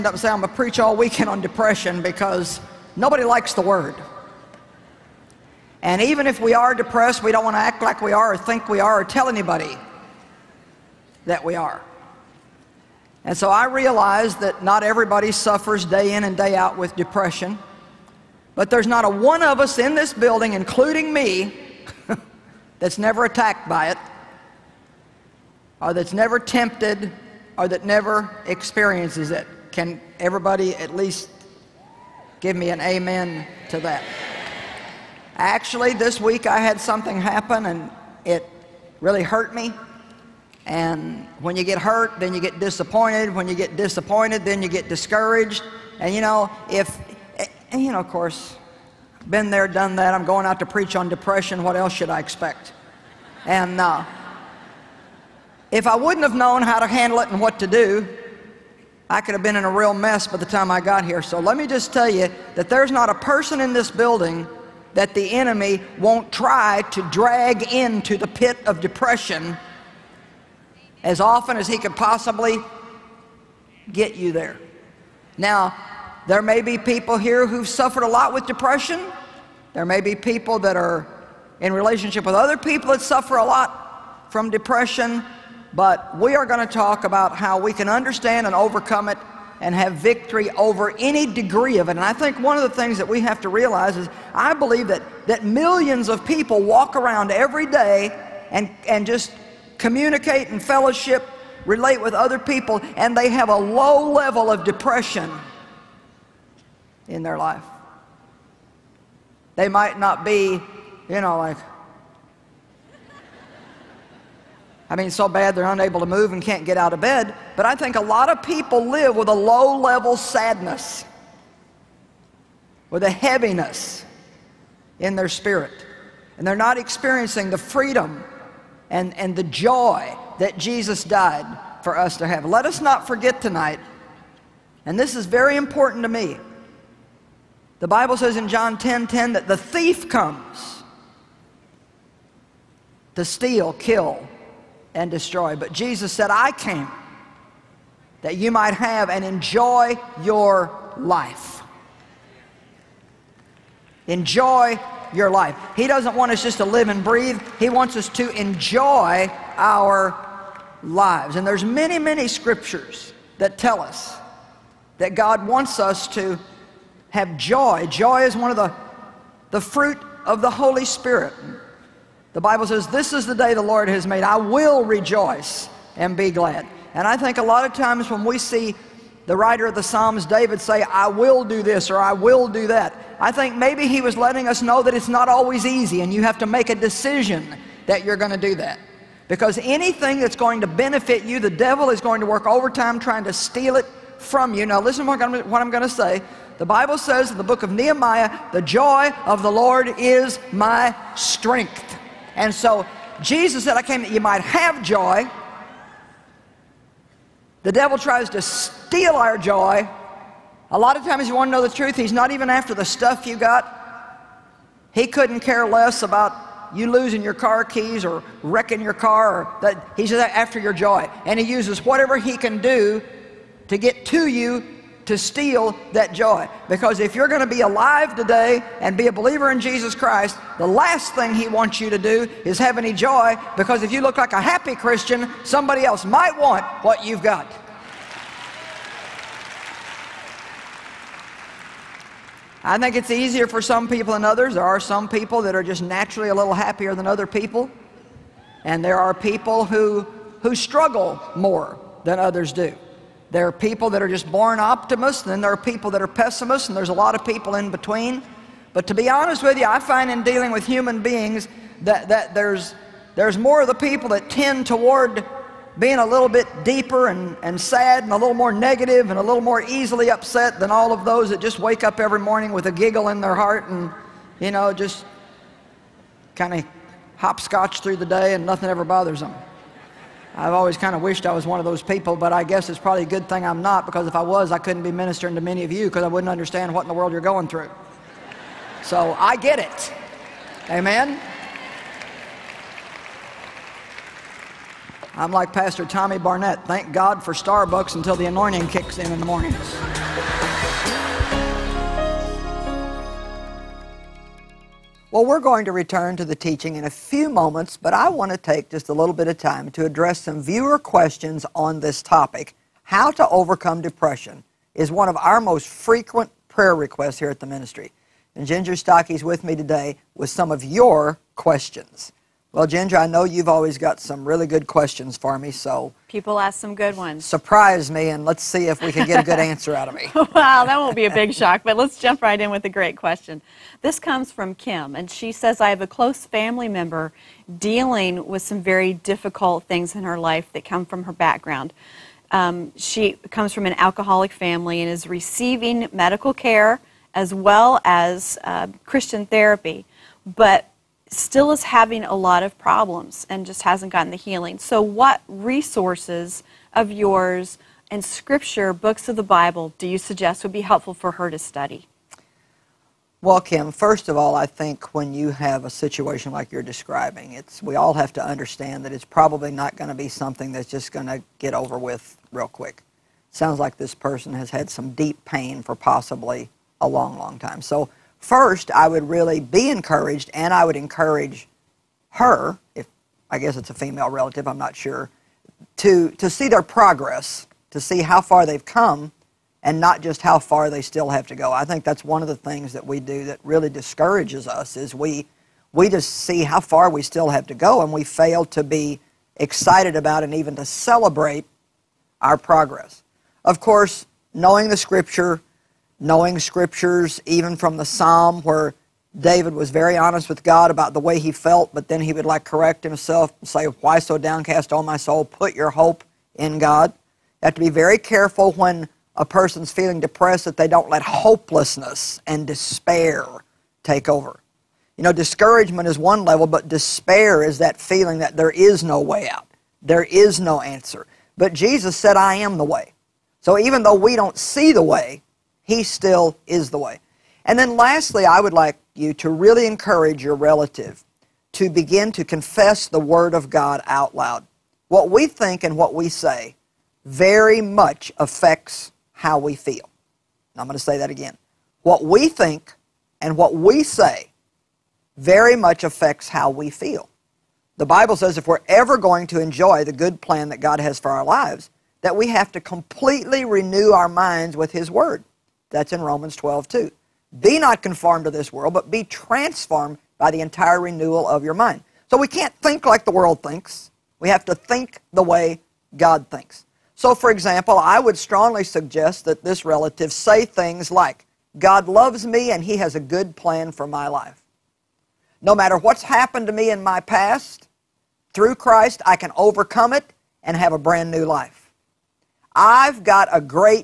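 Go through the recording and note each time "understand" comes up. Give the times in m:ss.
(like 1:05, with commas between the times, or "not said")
1:27, 4:46, 6:08.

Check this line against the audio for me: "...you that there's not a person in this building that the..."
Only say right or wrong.
right.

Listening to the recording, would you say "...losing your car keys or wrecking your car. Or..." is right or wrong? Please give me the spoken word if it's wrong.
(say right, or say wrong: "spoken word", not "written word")
right.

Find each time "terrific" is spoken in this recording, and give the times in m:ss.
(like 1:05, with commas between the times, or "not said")
not said.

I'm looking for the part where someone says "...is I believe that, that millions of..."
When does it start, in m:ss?
1:33.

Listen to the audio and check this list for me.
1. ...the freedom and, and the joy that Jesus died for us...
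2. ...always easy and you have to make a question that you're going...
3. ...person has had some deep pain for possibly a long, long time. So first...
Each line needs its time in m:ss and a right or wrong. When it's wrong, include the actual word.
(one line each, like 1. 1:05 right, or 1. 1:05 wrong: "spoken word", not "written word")
1. 2:07 right
2. 3:05 wrong: "decision", not "question"
3. 6:13 right.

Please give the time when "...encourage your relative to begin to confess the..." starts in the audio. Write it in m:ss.
7:19.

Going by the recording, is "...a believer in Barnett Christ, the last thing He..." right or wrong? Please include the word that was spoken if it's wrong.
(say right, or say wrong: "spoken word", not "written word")
wrong: "Jesus", not "Barnett".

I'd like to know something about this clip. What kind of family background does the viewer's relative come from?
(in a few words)
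Alcoholic.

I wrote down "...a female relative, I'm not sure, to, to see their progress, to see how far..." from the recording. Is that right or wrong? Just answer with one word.
right.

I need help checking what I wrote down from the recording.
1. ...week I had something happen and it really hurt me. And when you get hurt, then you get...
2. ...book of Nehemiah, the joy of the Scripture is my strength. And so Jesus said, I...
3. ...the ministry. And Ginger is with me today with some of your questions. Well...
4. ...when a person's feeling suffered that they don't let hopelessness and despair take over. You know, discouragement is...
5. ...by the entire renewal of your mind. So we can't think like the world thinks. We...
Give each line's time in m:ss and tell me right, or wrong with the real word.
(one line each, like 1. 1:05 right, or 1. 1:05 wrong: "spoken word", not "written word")
1. 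0:36 right
2. 3:17 wrong: "Lord", not "Scripture"
3. 5:17 right
4. 6:58 wrong: "depressed", not "suffered"
5. 7:50 right.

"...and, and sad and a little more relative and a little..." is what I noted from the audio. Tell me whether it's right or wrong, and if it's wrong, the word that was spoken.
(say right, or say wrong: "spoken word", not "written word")
wrong: "negative", not "relative".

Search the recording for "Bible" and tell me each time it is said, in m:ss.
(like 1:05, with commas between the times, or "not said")
2:17, 2:52, 3:16, 5:59, 7:37.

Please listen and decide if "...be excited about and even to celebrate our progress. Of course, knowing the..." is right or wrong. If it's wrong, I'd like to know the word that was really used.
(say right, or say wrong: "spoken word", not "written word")
right.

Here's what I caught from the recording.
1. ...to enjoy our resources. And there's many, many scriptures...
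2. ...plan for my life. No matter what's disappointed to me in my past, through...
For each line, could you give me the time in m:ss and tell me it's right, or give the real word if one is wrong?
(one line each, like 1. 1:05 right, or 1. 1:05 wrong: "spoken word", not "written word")
1. 2:38 wrong: "lives", not "resources"
2. 8:03 wrong: "happened", not "disappointed".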